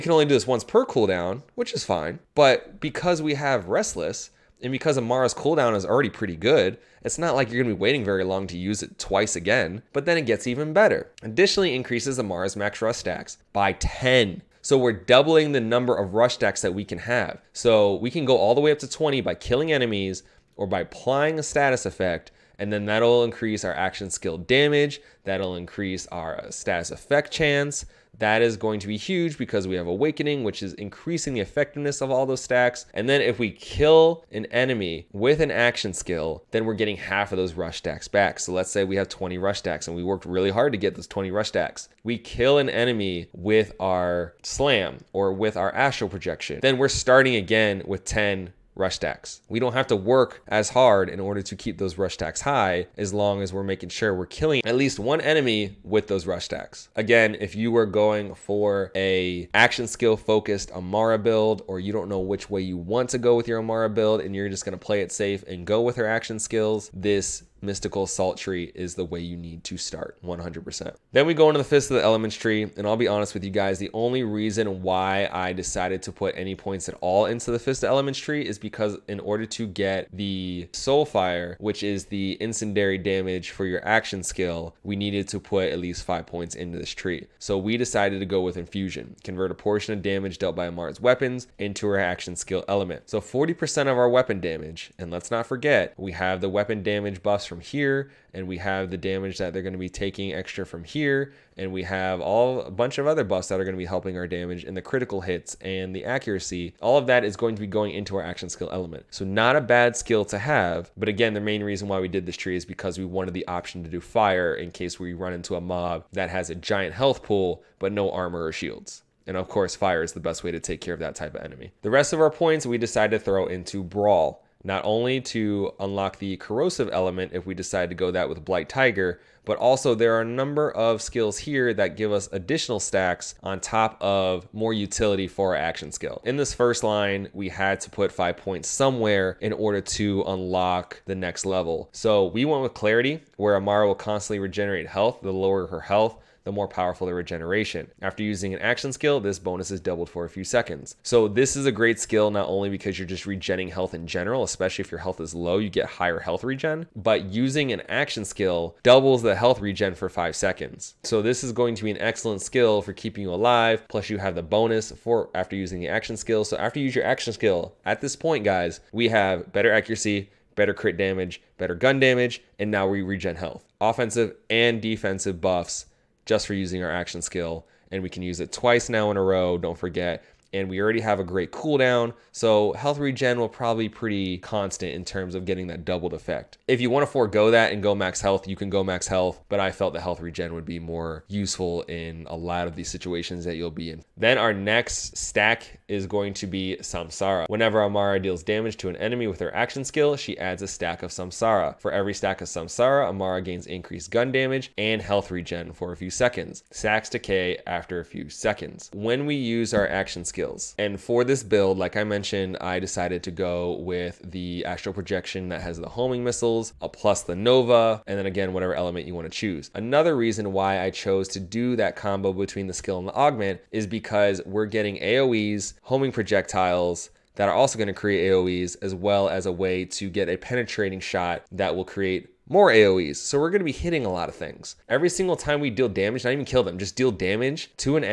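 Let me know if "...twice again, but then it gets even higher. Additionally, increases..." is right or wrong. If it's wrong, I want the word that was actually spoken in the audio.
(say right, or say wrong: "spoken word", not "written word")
wrong: "better", not "higher".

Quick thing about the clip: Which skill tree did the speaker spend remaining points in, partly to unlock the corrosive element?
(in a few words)
Brawl.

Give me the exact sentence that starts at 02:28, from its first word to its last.
After using an action skill, this bonus is doubled for a few seconds.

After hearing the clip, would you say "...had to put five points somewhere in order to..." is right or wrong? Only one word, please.
right.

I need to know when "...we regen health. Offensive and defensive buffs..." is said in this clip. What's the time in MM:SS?
02:52.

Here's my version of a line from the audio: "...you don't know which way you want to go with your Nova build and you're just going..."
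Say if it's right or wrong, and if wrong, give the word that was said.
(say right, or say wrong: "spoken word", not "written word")
wrong: "Amara", not "Nova".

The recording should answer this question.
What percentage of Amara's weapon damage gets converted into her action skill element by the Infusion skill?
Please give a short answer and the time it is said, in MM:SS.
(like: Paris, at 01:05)
40%, at 01:33.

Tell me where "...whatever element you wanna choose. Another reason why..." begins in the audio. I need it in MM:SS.
03:38.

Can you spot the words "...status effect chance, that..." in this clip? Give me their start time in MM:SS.
00:26.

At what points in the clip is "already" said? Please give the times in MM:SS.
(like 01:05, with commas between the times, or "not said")
00:05, 03:00.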